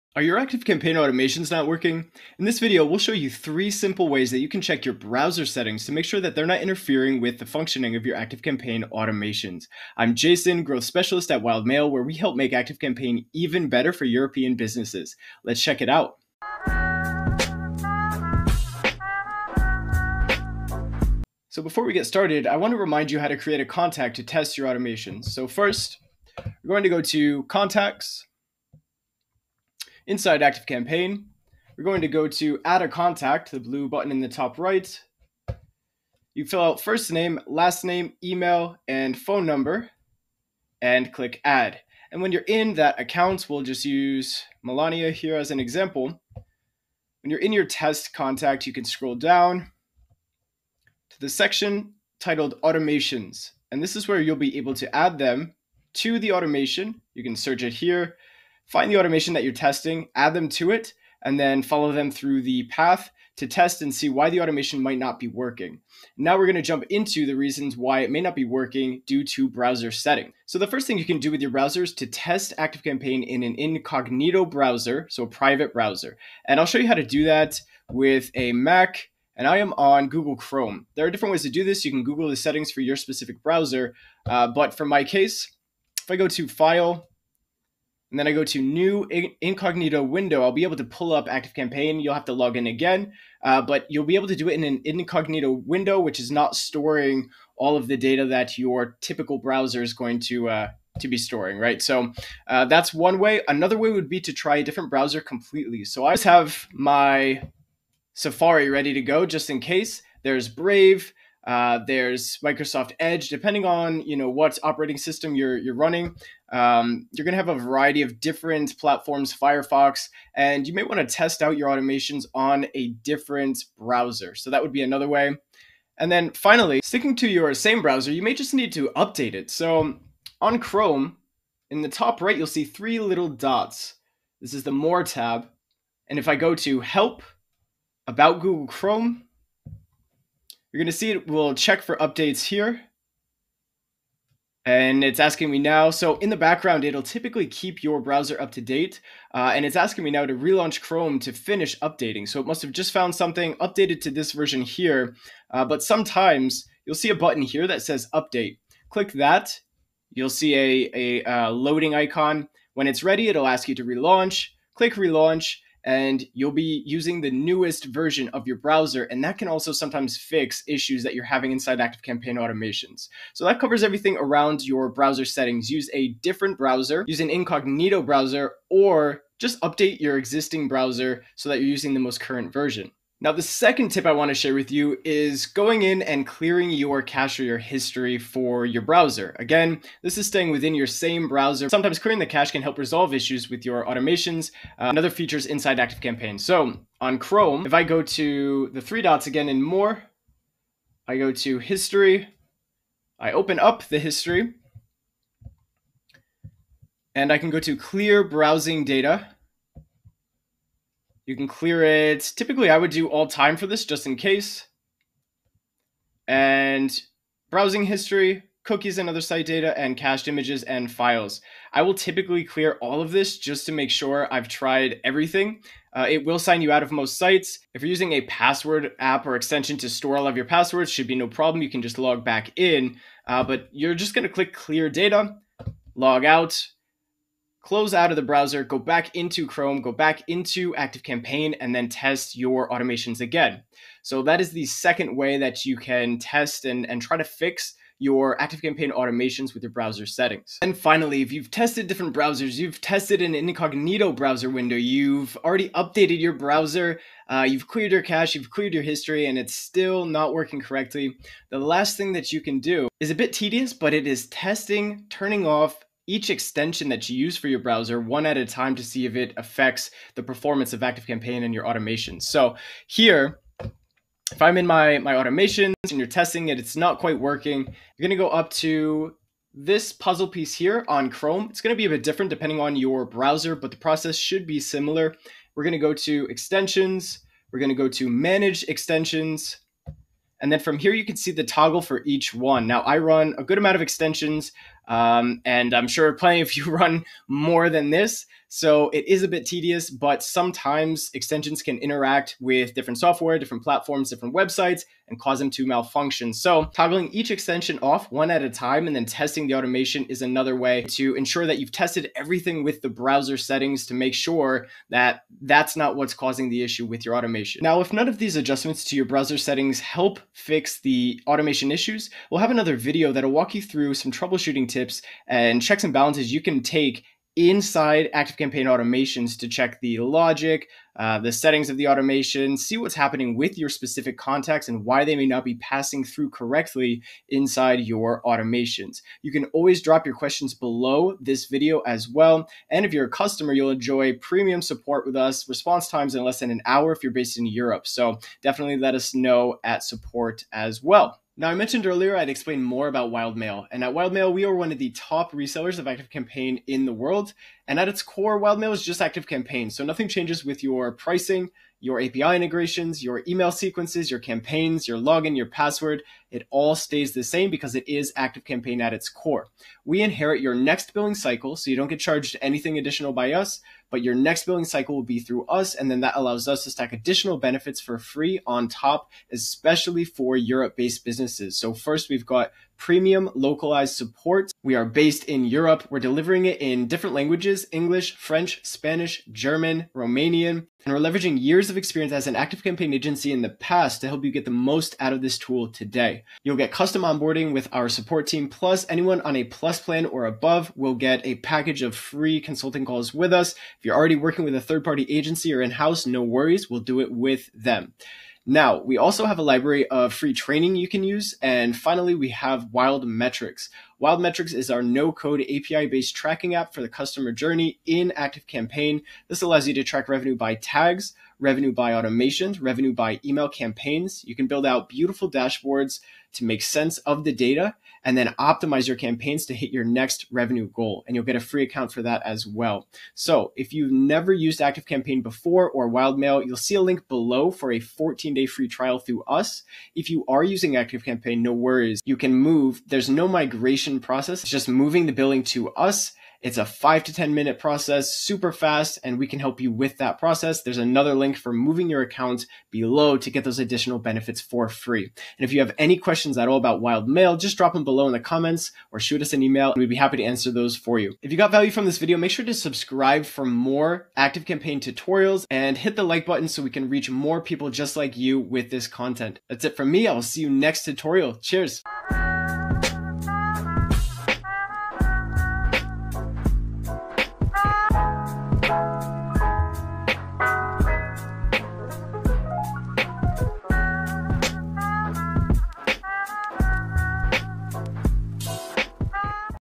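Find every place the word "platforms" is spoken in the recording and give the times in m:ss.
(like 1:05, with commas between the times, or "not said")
1:58, 5:03.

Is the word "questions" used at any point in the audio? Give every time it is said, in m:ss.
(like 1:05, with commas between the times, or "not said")
5:40, 7:35.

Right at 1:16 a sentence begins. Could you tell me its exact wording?
And I'll show you how to do that with a Mac, and I am on Google Chrome.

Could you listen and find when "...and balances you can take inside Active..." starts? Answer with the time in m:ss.
5:25.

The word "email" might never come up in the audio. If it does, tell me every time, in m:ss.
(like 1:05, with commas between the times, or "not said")
0:38, 6:03, 7:03, 7:39.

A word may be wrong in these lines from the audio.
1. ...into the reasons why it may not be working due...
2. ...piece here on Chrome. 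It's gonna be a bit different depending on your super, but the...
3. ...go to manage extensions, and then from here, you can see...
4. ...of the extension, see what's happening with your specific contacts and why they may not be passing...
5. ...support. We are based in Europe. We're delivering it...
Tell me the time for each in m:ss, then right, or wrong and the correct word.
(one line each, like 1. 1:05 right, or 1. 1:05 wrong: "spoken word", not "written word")
1. 1:06 right
2. 4:40 wrong: "browser", not "super"
3. 4:47 right
4. 5:31 wrong: "automation", not "extension"
5. 6:23 right.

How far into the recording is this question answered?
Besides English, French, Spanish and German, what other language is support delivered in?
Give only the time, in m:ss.
6:29.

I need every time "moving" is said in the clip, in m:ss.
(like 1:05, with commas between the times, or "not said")
7:24, 7:31.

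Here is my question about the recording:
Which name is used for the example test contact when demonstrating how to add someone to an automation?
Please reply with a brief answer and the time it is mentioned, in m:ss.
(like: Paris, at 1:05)
Melania, at 0:44.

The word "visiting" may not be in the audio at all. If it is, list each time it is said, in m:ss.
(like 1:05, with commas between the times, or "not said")
not said.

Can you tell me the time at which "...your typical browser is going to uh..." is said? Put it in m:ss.
1:38.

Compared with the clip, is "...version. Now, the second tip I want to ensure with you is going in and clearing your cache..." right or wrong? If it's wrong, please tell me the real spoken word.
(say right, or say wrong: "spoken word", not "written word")
wrong: "share", not "ensure".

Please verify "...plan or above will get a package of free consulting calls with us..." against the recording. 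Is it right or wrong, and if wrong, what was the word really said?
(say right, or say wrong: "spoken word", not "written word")
right.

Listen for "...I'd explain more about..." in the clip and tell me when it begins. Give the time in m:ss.
5:52.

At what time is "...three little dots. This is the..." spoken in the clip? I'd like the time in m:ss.
2:12.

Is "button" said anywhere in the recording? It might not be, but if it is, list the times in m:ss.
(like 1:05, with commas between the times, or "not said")
0:33, 2:37, 7:46.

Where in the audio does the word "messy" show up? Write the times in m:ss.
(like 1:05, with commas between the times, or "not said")
not said.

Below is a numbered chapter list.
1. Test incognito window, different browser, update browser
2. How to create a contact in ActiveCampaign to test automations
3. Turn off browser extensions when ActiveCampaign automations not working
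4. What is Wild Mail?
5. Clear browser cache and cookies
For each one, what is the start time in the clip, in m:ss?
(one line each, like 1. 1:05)
1. 1:12
2. 0:21
3. 4:11
4. 5:51
5. 3:03.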